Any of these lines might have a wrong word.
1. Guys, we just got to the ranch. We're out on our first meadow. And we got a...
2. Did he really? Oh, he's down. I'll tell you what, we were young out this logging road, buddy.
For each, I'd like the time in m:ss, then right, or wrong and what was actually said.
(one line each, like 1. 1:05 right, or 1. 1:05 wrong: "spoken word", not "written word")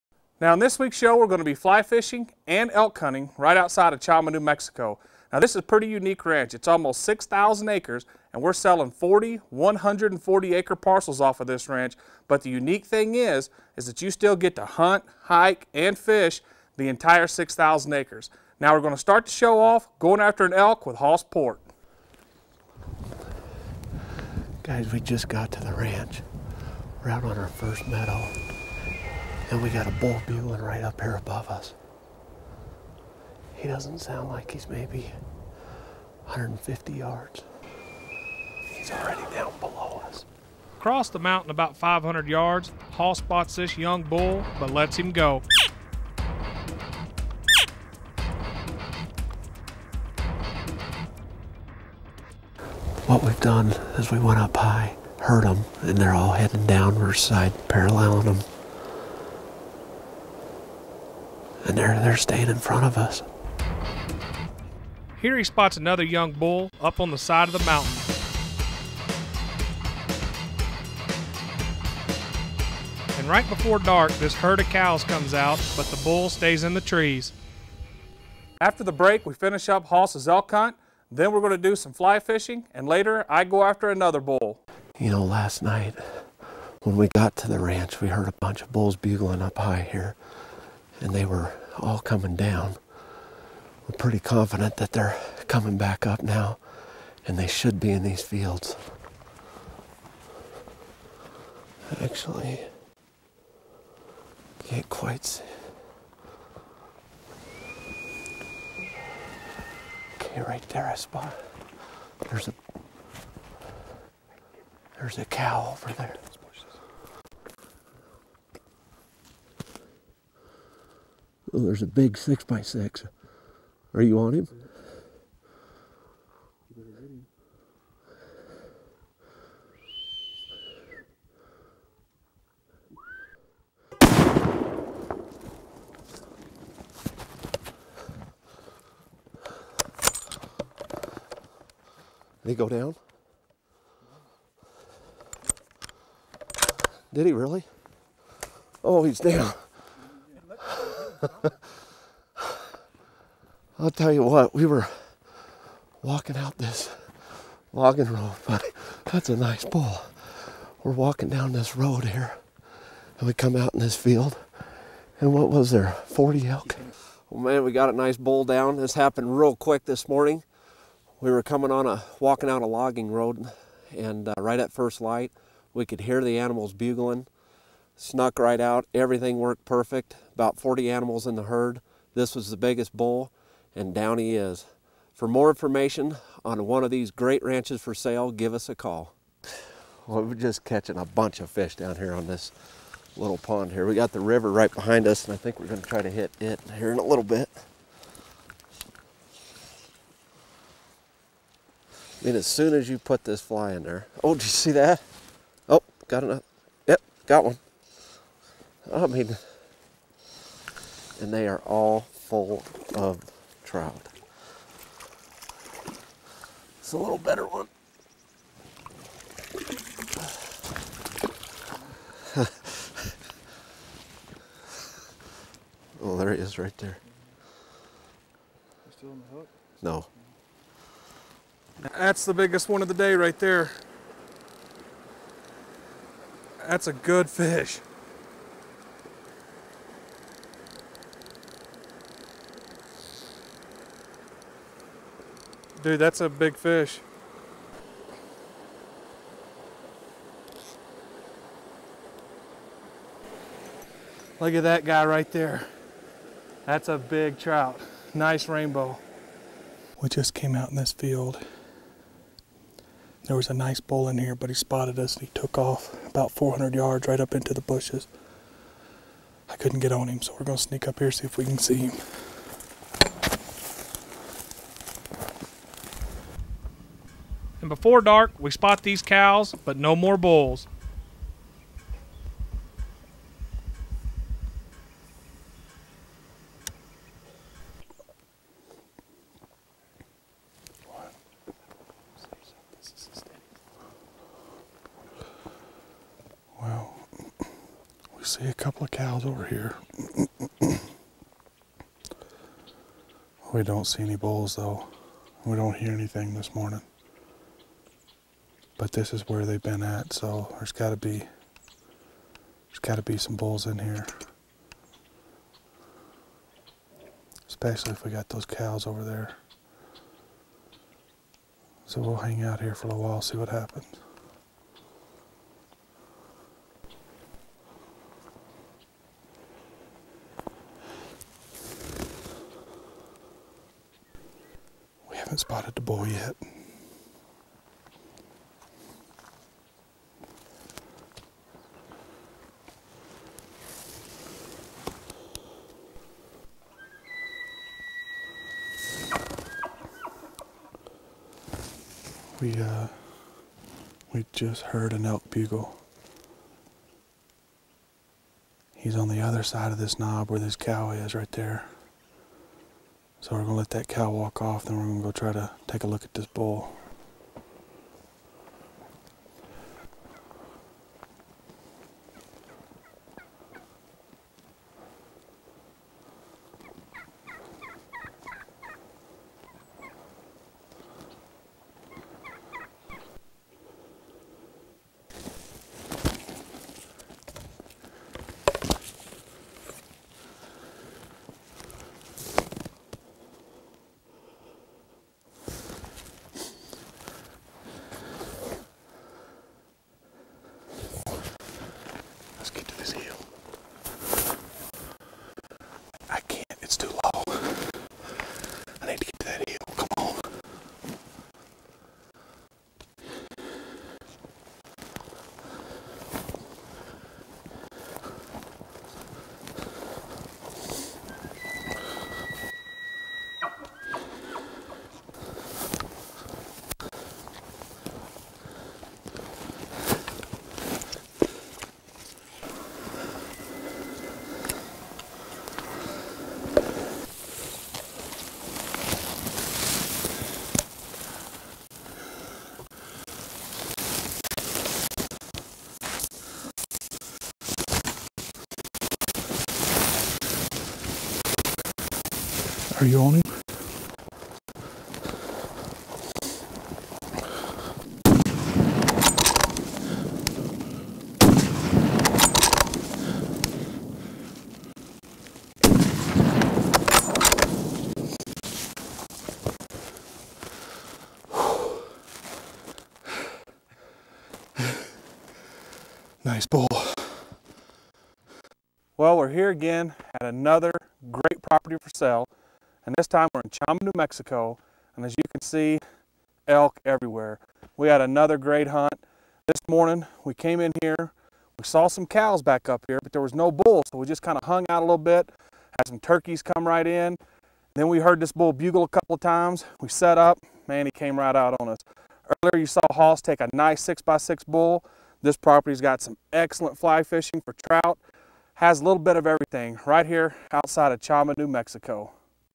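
1. 0:24 right
2. 2:27 wrong: "walking", not "young".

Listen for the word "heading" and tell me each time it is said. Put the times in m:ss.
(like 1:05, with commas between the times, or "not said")
0:56.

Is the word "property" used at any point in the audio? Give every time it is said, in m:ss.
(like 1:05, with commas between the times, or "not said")
8:01, 8:25.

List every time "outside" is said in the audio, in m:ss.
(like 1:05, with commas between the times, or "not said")
0:03, 8:30.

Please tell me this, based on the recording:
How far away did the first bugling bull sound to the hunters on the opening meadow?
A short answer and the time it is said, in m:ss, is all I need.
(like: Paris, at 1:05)
150 yards, at 0:36.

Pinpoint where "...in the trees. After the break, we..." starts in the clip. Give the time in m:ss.
1:16.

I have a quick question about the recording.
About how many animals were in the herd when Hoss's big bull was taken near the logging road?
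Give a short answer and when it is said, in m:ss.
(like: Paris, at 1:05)
40, at 2:46.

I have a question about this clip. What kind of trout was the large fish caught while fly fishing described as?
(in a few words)
Rainbow.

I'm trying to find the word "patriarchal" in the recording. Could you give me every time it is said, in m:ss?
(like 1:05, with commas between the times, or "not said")
not said.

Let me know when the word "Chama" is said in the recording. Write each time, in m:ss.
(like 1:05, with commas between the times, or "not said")
0:03, 8:03, 8:30.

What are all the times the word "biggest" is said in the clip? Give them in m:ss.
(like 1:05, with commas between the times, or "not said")
3:02, 3:52.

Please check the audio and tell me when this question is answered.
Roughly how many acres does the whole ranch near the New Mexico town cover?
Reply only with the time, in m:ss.
0:06.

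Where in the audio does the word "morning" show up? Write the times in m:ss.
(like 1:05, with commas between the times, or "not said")
2:50, 5:06, 8:09.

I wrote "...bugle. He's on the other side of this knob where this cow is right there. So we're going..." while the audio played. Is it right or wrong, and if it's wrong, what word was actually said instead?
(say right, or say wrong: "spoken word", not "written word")
right.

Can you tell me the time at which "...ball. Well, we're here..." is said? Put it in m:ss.
7:56.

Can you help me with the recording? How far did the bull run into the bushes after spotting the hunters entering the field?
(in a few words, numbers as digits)
400 yards.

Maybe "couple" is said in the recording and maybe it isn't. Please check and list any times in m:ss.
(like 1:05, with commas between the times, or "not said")
4:58, 8:18.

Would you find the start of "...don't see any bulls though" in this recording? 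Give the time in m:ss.
5:03.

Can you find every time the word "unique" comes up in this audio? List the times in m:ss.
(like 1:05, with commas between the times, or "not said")
0:05, 0:12.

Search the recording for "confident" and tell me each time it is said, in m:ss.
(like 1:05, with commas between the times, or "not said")
1:34.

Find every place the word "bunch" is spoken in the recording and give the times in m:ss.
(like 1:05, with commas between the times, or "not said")
1:28, 3:11.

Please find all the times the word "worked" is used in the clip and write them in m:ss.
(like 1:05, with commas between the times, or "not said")
2:59.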